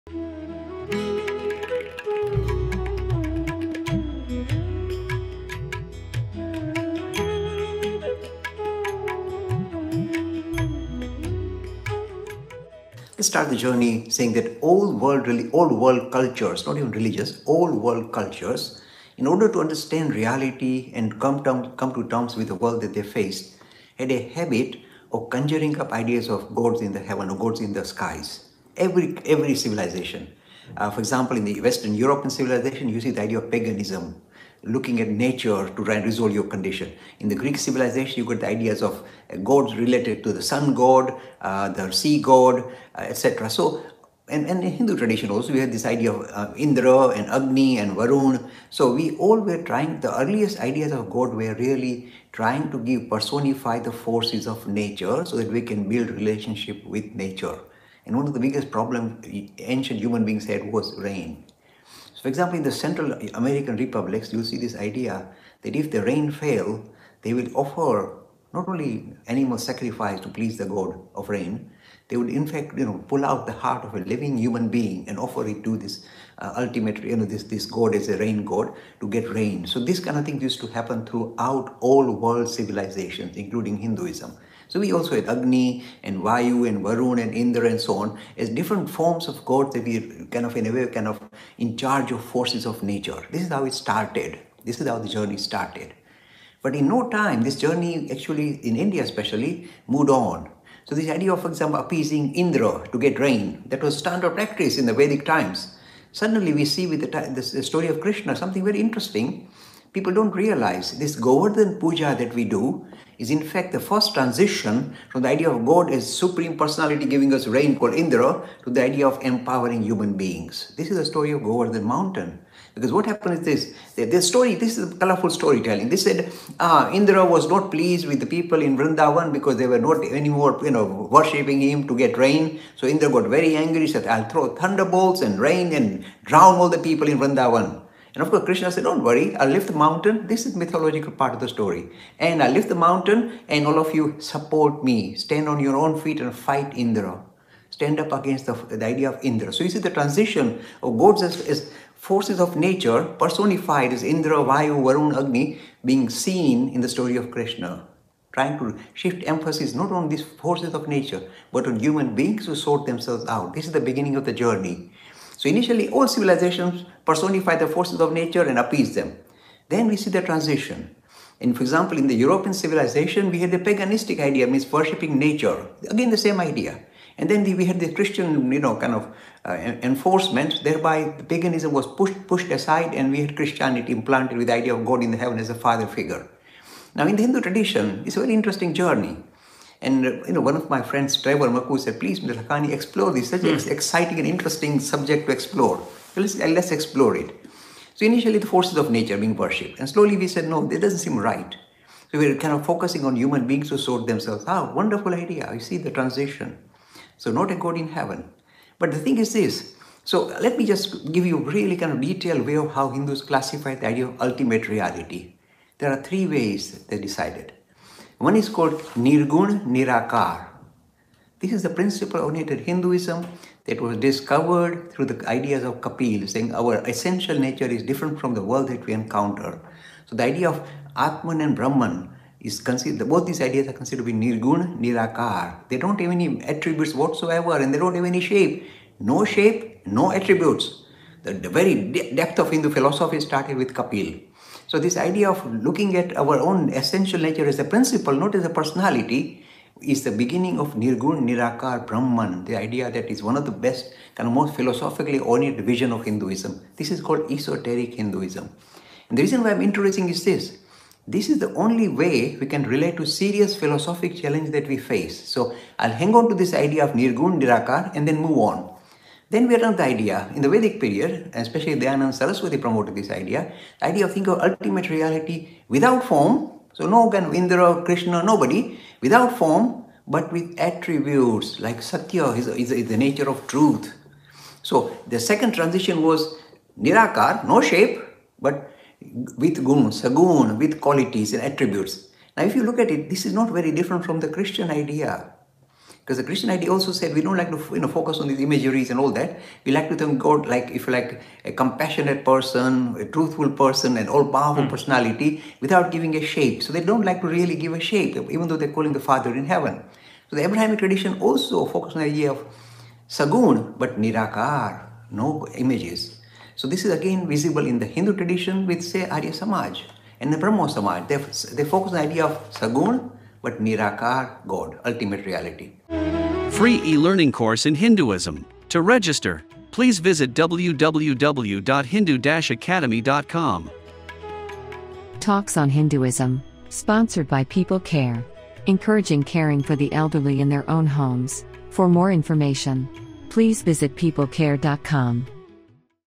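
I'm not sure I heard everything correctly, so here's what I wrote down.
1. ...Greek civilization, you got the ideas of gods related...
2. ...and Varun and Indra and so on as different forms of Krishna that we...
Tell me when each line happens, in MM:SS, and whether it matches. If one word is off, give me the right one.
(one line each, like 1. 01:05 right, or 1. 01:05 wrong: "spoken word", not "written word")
1. 00:37 right
2. 01:26 wrong: "God", not "Krishna".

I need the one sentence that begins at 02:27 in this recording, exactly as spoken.
Stand up against the, the idea of Indra.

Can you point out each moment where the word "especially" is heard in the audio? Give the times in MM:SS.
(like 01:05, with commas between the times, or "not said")
01:39, 04:31.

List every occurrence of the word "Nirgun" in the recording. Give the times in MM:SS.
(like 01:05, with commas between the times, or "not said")
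03:38, 03:54, 04:10, 04:26.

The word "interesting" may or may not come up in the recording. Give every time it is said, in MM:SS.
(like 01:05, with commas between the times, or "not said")
01:48, 03:08, 03:14.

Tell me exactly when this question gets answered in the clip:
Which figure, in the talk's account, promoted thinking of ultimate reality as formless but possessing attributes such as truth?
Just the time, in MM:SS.
04:31.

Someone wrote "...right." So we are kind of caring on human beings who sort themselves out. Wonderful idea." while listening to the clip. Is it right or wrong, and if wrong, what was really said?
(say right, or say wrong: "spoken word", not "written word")
wrong: "focusing", not "caring".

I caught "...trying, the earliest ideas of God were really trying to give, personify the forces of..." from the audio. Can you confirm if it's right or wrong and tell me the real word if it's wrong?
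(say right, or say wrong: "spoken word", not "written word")
right.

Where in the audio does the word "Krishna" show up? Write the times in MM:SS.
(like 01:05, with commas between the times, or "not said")
01:47, 02:18, 02:37, 04:37.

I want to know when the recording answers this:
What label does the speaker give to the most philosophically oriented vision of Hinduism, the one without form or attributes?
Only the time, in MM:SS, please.
04:17.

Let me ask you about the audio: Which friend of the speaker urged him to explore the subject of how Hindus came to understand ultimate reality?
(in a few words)
Trevor Maku.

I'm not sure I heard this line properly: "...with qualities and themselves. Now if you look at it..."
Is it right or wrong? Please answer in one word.
wrong.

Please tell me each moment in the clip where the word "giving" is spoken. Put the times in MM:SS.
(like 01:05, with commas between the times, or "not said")
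01:57, 05:05.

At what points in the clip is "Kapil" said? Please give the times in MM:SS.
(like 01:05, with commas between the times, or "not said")
03:45, 04:03.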